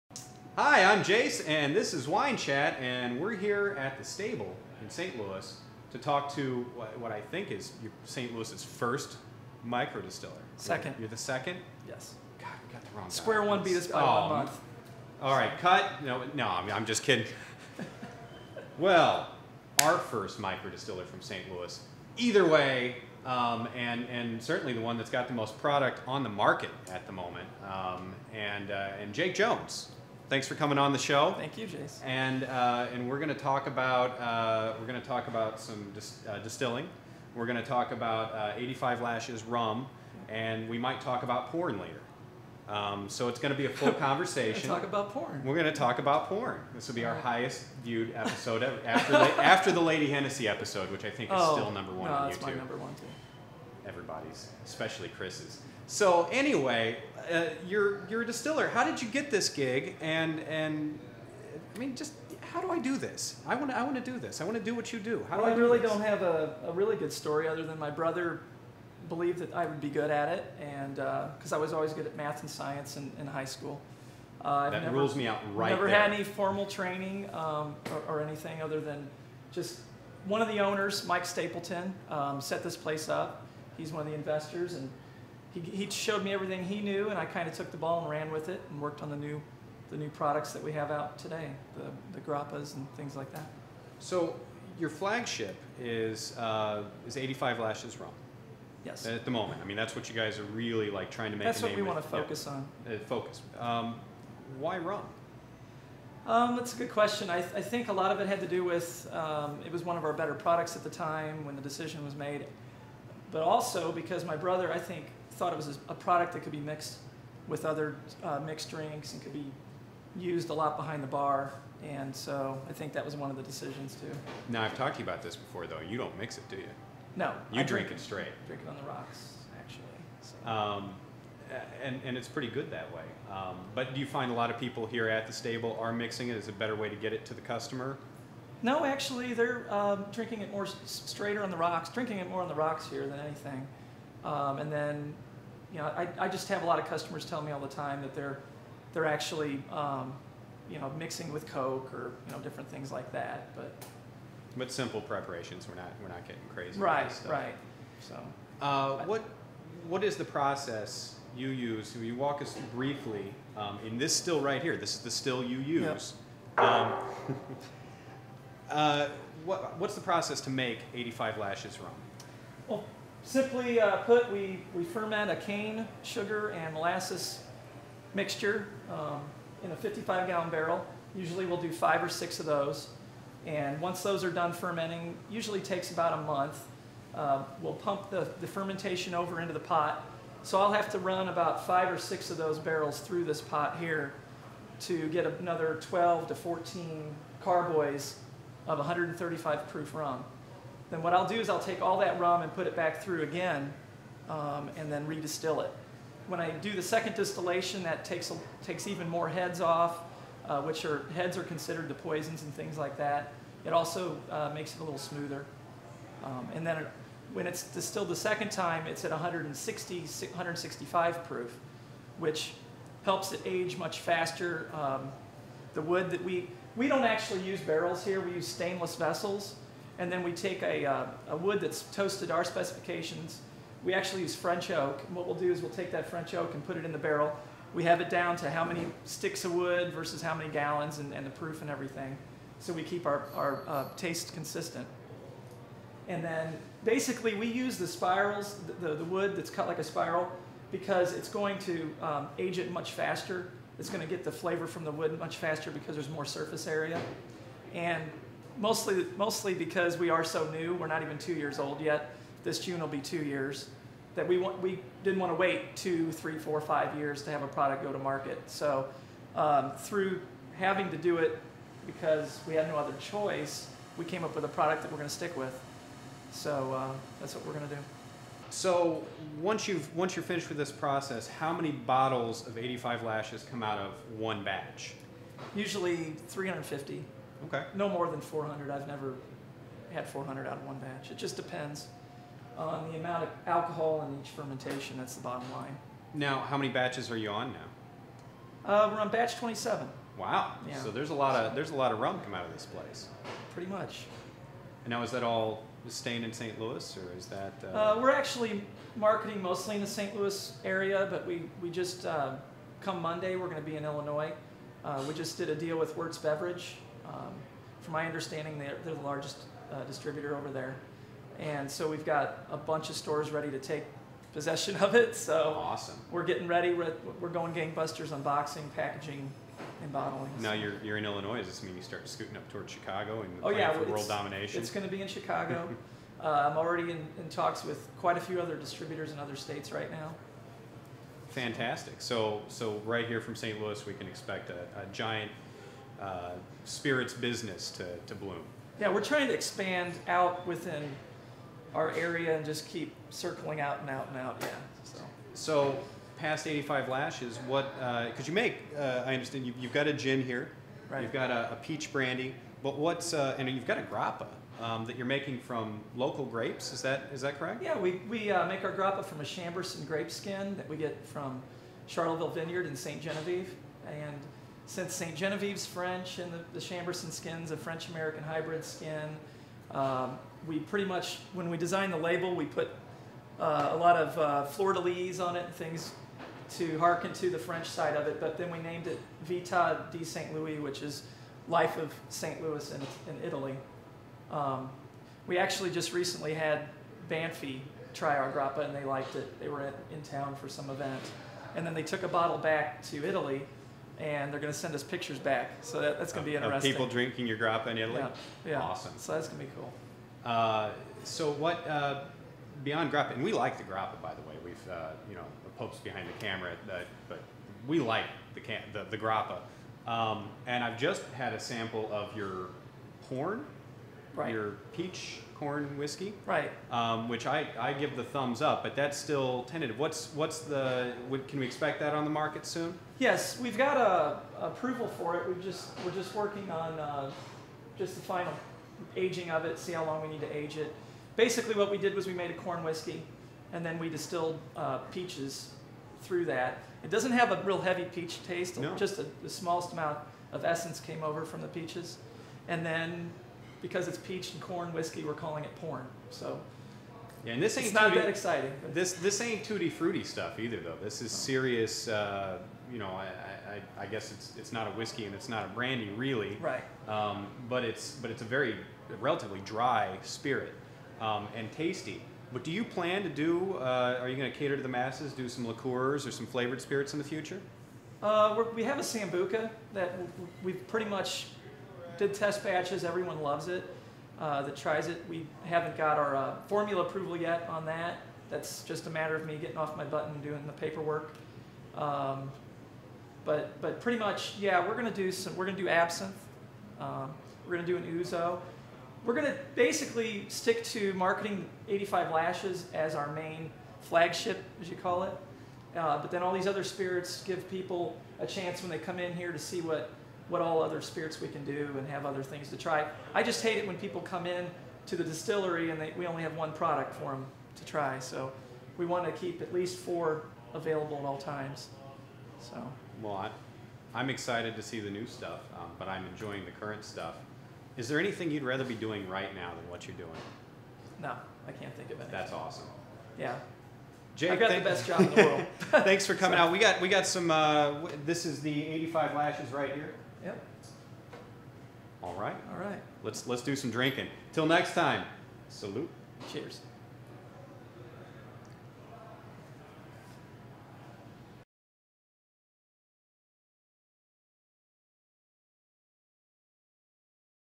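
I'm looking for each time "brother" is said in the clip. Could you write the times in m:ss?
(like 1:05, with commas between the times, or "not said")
1:07, 1:54.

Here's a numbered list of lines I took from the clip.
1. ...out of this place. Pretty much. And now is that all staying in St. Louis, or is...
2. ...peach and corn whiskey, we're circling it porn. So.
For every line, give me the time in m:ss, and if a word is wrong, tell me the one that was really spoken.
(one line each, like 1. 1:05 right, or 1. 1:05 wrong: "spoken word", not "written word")
1. 5:02 right
2. 7:33 wrong: "calling", not "circling".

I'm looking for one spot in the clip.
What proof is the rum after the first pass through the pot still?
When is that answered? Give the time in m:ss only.
3:18.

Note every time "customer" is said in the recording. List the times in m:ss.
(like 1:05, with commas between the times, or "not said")
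2:17, 2:26.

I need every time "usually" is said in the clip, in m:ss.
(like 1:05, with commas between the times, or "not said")
3:01, 3:05, 4:45.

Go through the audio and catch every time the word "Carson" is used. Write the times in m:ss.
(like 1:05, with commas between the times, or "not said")
not said.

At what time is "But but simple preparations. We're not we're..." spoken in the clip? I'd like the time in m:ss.
2:33.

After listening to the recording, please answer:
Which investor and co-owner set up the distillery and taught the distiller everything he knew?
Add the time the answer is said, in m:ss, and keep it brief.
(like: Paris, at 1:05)
Mike Stapleton, at 1:21.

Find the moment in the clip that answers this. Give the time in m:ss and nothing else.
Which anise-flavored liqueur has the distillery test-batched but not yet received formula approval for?
7:58.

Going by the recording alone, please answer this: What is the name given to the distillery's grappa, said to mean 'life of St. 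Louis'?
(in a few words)
Vita di St. Louis.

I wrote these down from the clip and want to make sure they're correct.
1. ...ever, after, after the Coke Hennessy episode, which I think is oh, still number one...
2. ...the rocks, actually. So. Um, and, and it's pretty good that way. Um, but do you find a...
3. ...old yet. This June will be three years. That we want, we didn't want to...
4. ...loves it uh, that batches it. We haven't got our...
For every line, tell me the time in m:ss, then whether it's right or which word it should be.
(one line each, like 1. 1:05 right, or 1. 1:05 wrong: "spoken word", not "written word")
1. 0:48 wrong: "Lady", not "Coke"
2. 2:08 right
3. 4:21 wrong: "two", not "three"
4. 8:03 wrong: "tries", not "batches".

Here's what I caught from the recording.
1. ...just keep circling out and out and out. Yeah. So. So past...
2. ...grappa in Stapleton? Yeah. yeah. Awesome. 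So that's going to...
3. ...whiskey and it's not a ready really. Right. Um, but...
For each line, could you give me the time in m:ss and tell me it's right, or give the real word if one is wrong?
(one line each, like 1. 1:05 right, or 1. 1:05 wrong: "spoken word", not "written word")
1. 5:52 right
2. 6:47 wrong: "Italy", not "Stapleton"
3. 7:44 wrong: "brandy", not "ready".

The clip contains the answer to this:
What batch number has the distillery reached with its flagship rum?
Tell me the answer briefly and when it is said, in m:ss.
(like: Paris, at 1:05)
27, at 4:59.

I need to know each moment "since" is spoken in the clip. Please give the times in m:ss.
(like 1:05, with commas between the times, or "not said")
6:14.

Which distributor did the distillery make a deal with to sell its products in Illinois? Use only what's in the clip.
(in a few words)
Wirtz Beverage.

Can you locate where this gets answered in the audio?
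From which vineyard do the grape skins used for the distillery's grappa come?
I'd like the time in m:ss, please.
6:11.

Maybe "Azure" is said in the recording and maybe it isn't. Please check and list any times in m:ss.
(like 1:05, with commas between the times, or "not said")
not said.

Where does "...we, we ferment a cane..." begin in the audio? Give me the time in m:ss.
2:54.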